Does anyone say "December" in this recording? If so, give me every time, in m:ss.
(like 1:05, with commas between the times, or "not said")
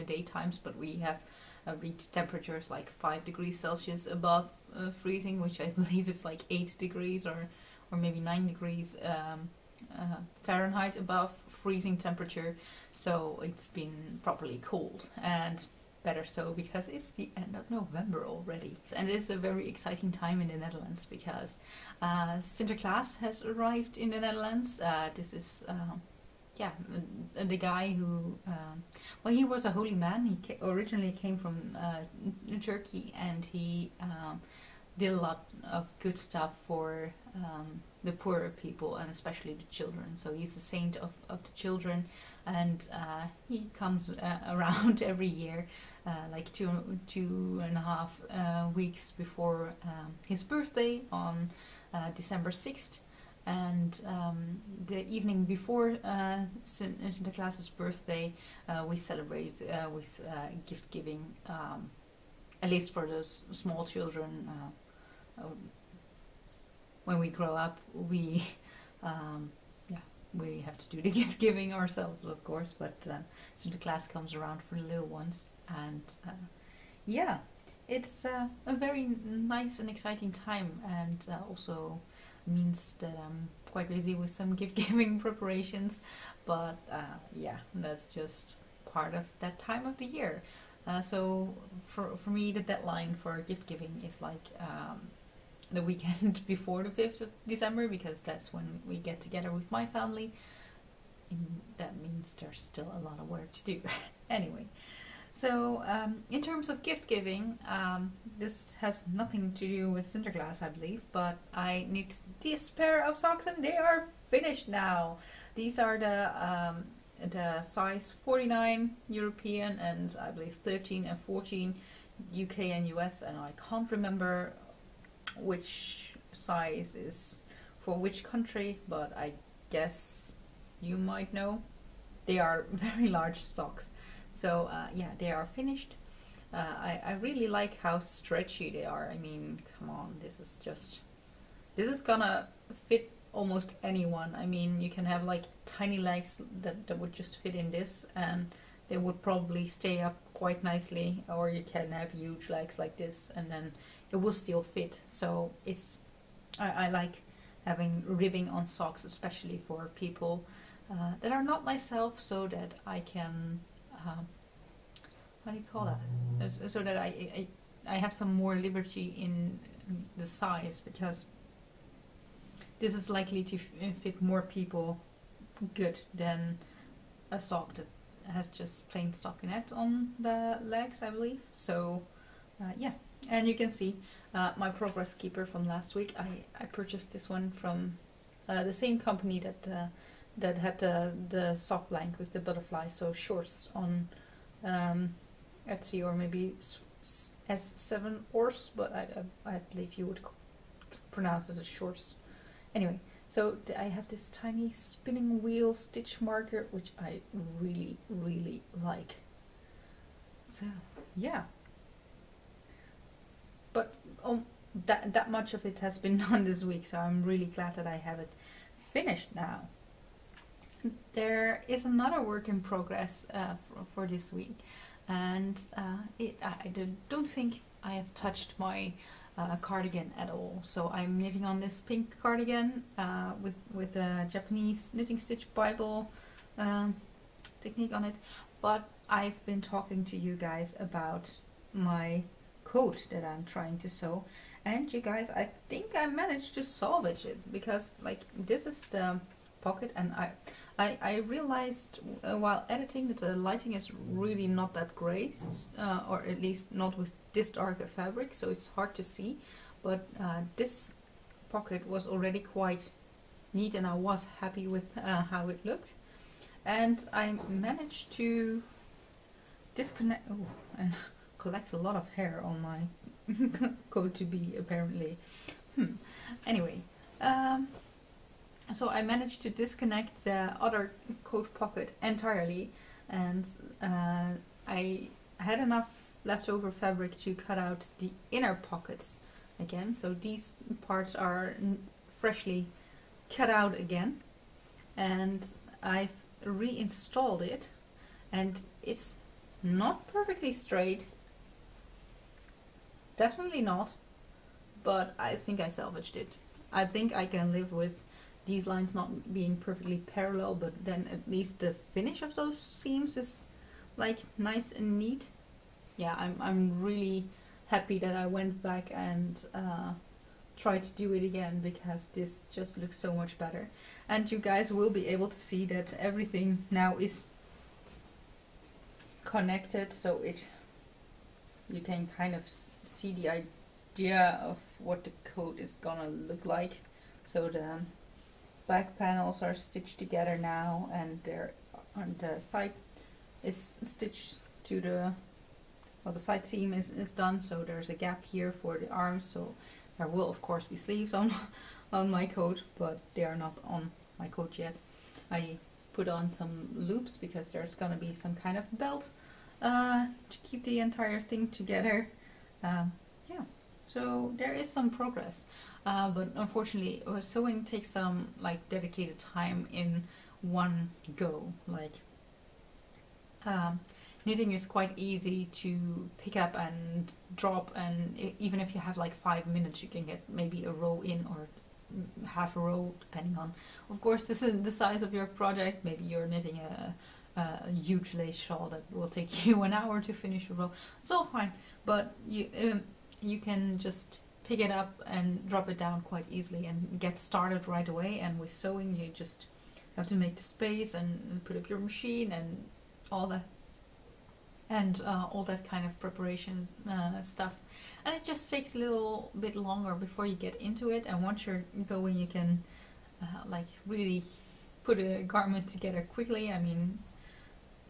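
0:52, 1:37.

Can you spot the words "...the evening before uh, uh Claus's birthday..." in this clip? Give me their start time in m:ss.
0:54.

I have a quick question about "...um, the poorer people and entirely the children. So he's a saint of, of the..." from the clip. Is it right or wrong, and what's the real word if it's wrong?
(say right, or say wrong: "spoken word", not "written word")
wrong: "especially", not "entirely".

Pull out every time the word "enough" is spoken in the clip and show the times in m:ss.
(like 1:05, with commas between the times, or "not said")
4:45.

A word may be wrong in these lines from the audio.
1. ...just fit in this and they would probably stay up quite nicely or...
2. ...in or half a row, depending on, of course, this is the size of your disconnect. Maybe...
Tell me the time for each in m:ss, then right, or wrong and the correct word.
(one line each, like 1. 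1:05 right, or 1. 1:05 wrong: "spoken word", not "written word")
1. 2:27 right
2. 6:21 wrong: "project", not "disconnect".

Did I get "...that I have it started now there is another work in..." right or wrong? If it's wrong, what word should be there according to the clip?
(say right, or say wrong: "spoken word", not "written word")
wrong: "finished", not "started".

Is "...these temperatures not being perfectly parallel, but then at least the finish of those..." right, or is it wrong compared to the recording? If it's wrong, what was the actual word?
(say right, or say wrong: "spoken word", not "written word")
wrong: "lines", not "temperatures".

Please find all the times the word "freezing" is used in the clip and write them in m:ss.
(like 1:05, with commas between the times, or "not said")
0:04, 0:11.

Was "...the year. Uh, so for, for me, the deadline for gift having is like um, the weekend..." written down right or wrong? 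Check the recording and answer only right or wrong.
wrong.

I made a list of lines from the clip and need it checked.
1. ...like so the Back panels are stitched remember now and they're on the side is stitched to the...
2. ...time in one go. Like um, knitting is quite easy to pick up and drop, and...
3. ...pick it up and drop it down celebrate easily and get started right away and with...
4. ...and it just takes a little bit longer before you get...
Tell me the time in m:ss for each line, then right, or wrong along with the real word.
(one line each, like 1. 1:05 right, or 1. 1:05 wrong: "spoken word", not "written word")
1. 5:36 wrong: "together", not "remember"
2. 6:09 right
3. 6:34 wrong: "quite", not "celebrate"
4. 6:48 right.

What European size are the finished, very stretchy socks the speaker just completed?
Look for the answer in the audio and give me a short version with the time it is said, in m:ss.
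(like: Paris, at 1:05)
49, at 1:57.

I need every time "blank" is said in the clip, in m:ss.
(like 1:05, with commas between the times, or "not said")
3:11.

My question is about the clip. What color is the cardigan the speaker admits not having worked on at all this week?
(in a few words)
Pink.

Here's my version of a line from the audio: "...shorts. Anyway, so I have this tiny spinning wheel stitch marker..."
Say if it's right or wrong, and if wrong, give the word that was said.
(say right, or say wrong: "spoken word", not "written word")
right.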